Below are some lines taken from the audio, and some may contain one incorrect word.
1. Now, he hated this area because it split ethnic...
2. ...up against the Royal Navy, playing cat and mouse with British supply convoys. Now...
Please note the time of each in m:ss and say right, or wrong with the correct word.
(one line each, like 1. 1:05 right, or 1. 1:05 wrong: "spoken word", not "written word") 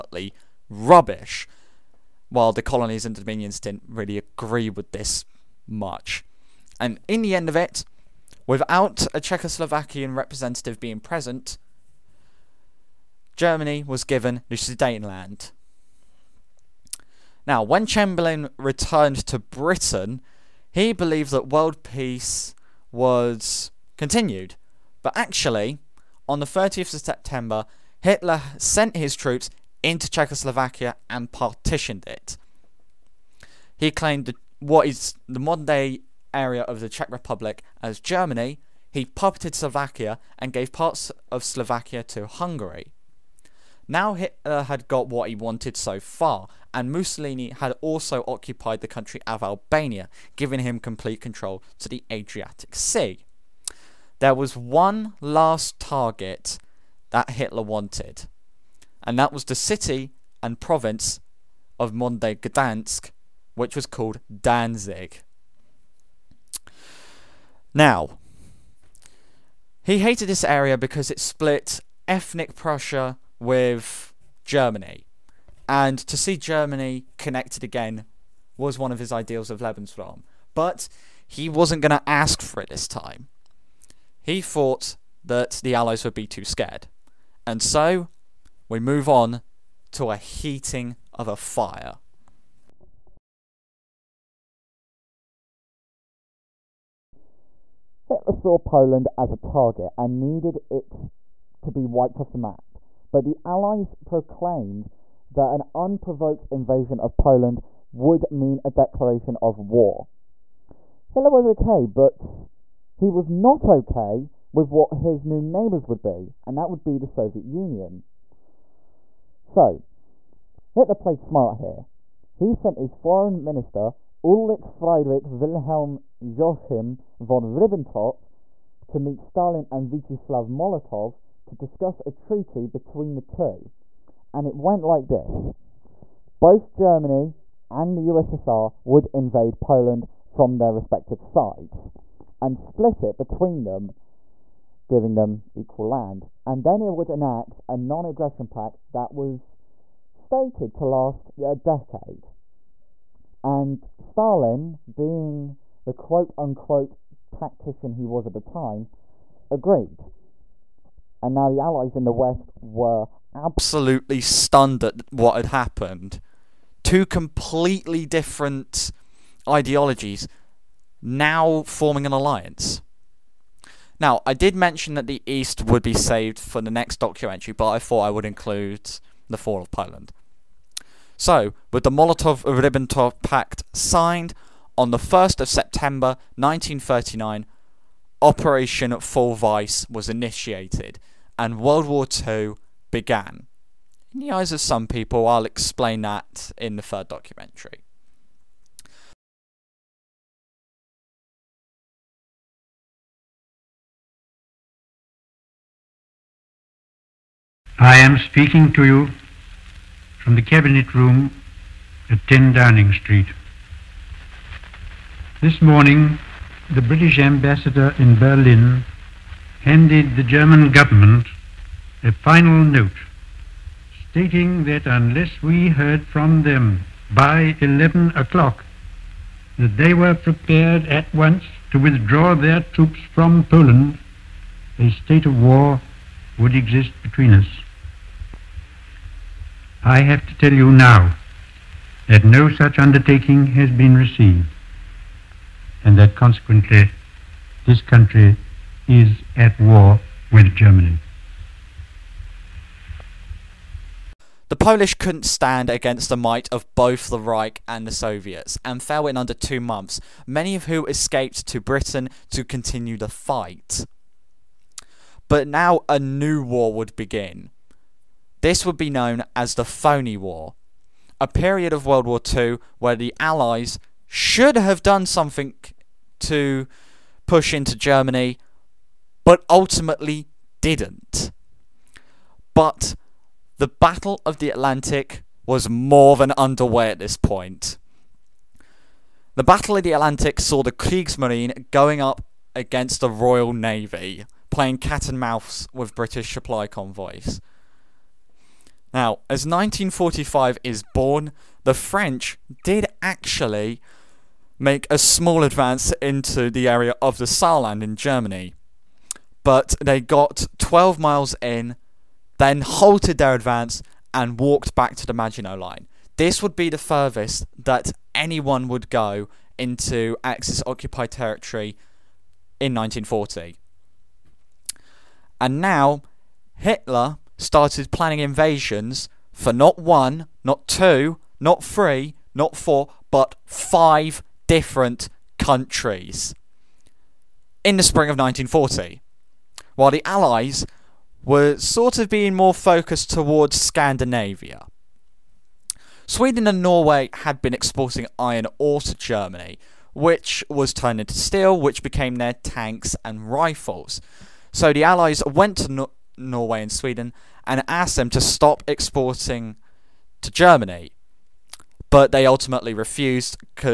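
1. 1:07 right
2. 4:52 right.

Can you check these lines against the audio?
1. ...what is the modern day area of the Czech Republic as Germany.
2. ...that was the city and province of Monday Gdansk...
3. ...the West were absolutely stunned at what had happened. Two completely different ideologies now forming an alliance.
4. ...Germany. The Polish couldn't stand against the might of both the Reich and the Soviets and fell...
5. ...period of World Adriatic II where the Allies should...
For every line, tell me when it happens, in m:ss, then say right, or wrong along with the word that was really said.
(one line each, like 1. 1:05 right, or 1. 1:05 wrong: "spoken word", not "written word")
1. 0:34 right
2. 0:59 right
3. 2:42 right
4. 4:10 right
5. 4:31 wrong: "War", not "Adriatic".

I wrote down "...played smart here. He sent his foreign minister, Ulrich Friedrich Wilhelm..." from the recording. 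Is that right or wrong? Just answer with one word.
right.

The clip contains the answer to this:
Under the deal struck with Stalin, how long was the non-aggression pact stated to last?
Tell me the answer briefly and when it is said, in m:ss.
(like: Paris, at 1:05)
A decade, at 2:31.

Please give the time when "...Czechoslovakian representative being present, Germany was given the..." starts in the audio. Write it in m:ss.
0:09.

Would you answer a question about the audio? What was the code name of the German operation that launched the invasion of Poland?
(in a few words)
Operation Fall Weiss.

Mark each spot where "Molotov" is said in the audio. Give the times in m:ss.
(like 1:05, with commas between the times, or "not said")
2:10, 3:01.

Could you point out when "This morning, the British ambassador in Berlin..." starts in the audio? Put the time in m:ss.
3:35.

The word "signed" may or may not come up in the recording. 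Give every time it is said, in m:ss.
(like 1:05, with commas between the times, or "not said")
3:03.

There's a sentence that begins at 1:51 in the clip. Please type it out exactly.
Hitler was okay, but he was not okay with what his new neighbours would be, and that would be the Soviet Union.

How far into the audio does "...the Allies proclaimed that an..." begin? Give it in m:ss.
1:43.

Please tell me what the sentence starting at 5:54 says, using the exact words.
So the Allies went to Norway and Sweden and asked them to stop exporting to Germany.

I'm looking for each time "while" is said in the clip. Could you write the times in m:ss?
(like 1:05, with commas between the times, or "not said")
0:02, 5:39.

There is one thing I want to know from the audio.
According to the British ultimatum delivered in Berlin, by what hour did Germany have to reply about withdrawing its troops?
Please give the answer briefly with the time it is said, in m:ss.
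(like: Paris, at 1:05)
11 o'clock, at 3:47.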